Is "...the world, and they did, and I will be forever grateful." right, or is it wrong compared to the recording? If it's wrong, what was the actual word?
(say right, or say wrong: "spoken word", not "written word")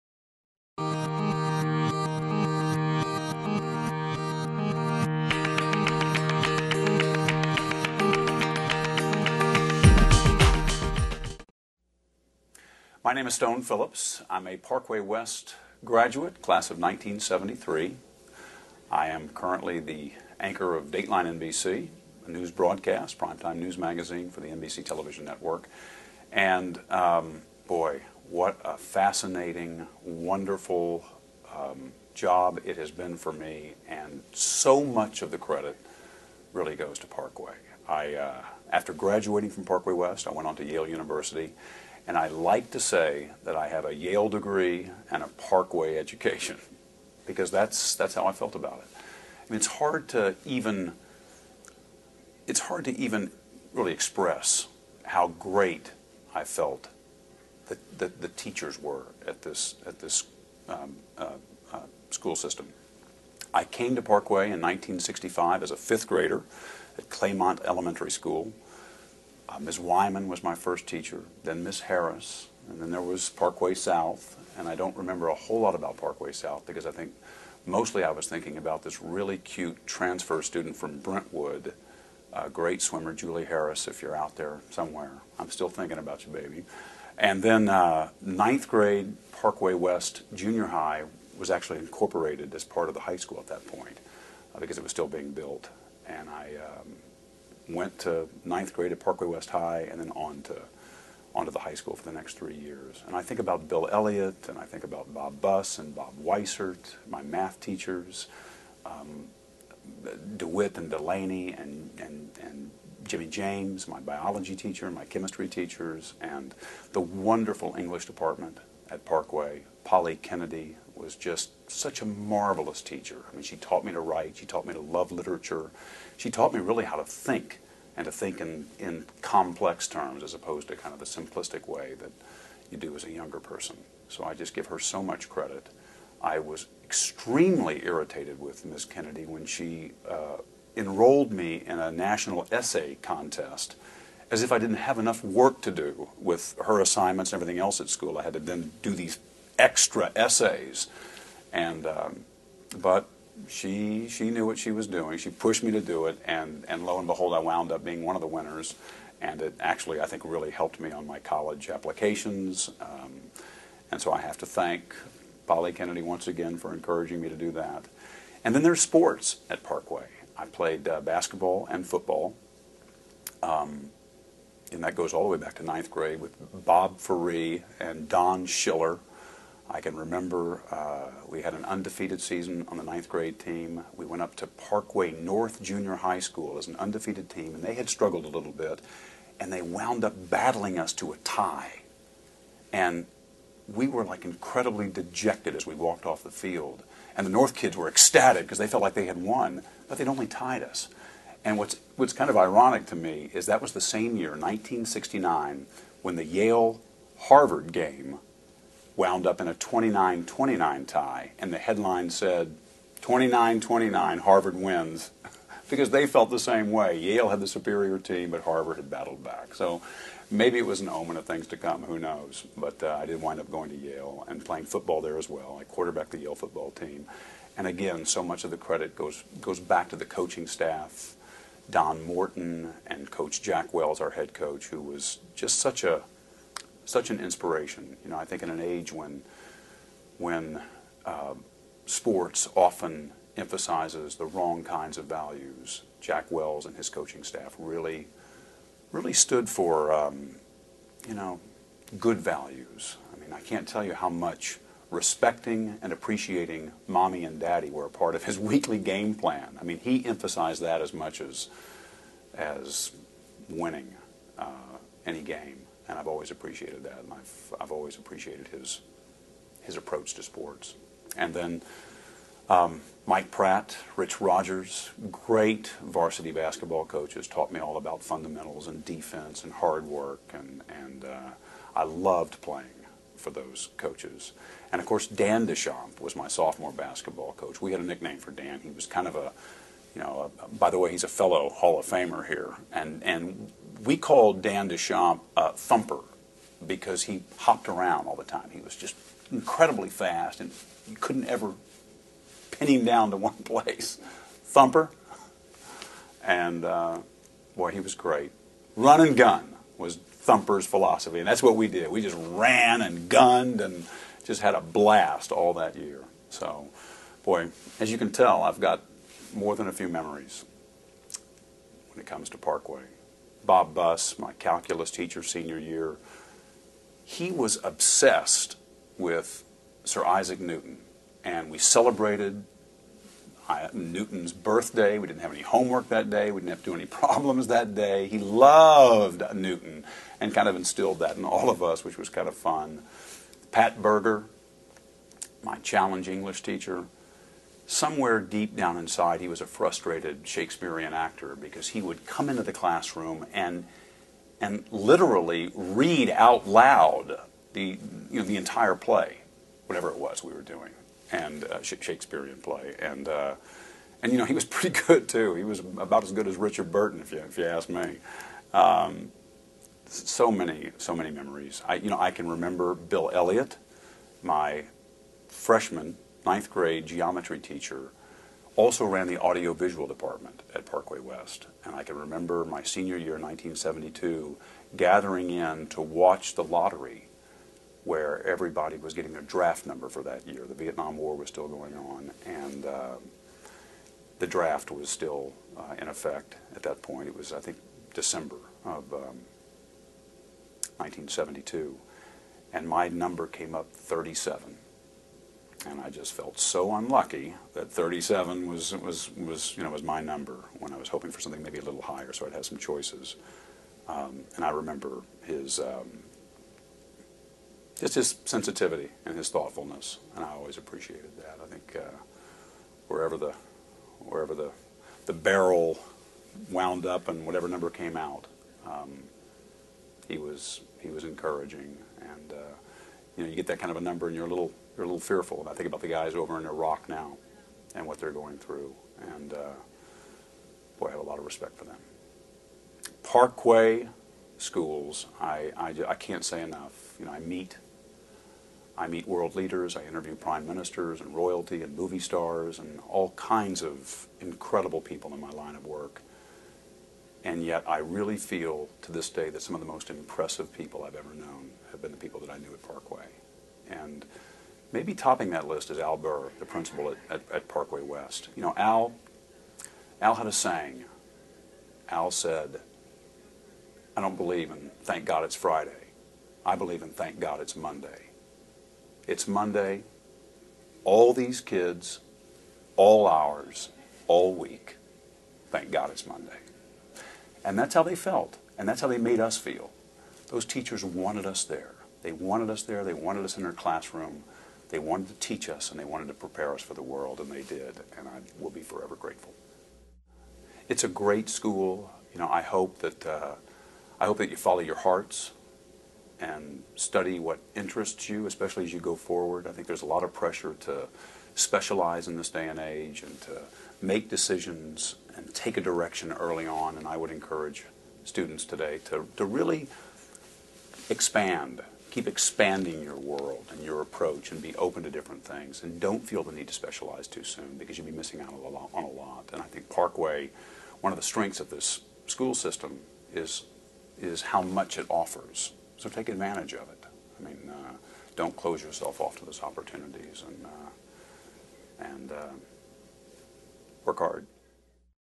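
right.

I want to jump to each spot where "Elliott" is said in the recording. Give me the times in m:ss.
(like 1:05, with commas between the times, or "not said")
1:43, 6:13.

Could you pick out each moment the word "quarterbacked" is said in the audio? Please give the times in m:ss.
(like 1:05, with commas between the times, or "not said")
3:45.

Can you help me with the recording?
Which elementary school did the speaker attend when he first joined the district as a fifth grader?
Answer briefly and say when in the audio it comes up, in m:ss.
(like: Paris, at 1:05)
Claymont Elementary School, at 1:07.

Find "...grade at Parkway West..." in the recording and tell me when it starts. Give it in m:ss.
1:38.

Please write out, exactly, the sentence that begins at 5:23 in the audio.
Bob Buss, my calculus teacher senior year, he was obsessed with Sir Isaac Newton.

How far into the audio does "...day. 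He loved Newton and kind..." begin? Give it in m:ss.
5:37.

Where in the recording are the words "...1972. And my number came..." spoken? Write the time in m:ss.
6:40.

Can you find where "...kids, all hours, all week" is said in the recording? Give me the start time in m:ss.
8:01.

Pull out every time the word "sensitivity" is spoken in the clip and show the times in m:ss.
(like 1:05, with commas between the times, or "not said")
6:58.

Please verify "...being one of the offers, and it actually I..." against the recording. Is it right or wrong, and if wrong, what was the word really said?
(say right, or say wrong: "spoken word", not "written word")
wrong: "winners", not "offers".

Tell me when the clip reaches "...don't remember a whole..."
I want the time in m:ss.
1:14.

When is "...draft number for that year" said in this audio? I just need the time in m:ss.
6:29.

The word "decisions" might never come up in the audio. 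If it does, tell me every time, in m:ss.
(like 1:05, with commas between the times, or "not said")
8:34.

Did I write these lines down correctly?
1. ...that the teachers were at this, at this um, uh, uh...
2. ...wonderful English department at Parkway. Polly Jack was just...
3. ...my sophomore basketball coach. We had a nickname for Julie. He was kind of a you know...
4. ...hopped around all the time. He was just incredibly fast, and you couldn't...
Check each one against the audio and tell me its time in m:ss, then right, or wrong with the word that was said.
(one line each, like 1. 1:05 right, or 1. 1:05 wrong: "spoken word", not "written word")
1. 0:57 right
2. 1:57 wrong: "Kennedy", not "Jack"
3. 4:46 wrong: "Dan", not "Julie"
4. 4:57 right.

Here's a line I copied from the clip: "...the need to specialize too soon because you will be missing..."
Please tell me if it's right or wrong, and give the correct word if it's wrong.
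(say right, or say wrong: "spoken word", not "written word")
right.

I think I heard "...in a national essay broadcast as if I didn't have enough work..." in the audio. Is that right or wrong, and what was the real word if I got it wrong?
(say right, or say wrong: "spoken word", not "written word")
wrong: "contest", not "broadcast".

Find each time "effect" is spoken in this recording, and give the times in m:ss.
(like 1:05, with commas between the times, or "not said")
6:35.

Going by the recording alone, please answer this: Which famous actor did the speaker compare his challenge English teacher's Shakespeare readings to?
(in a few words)
Richard Burton.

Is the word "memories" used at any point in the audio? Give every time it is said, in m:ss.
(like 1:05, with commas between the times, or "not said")
5:19, 6:11.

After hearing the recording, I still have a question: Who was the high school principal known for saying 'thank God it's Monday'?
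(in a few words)
Al Burr.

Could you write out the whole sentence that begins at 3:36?
Yale had the superior team, but Harvard had battled back.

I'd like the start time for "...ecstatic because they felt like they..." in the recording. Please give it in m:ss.
3:17.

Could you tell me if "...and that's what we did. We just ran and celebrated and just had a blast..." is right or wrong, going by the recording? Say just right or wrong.
wrong.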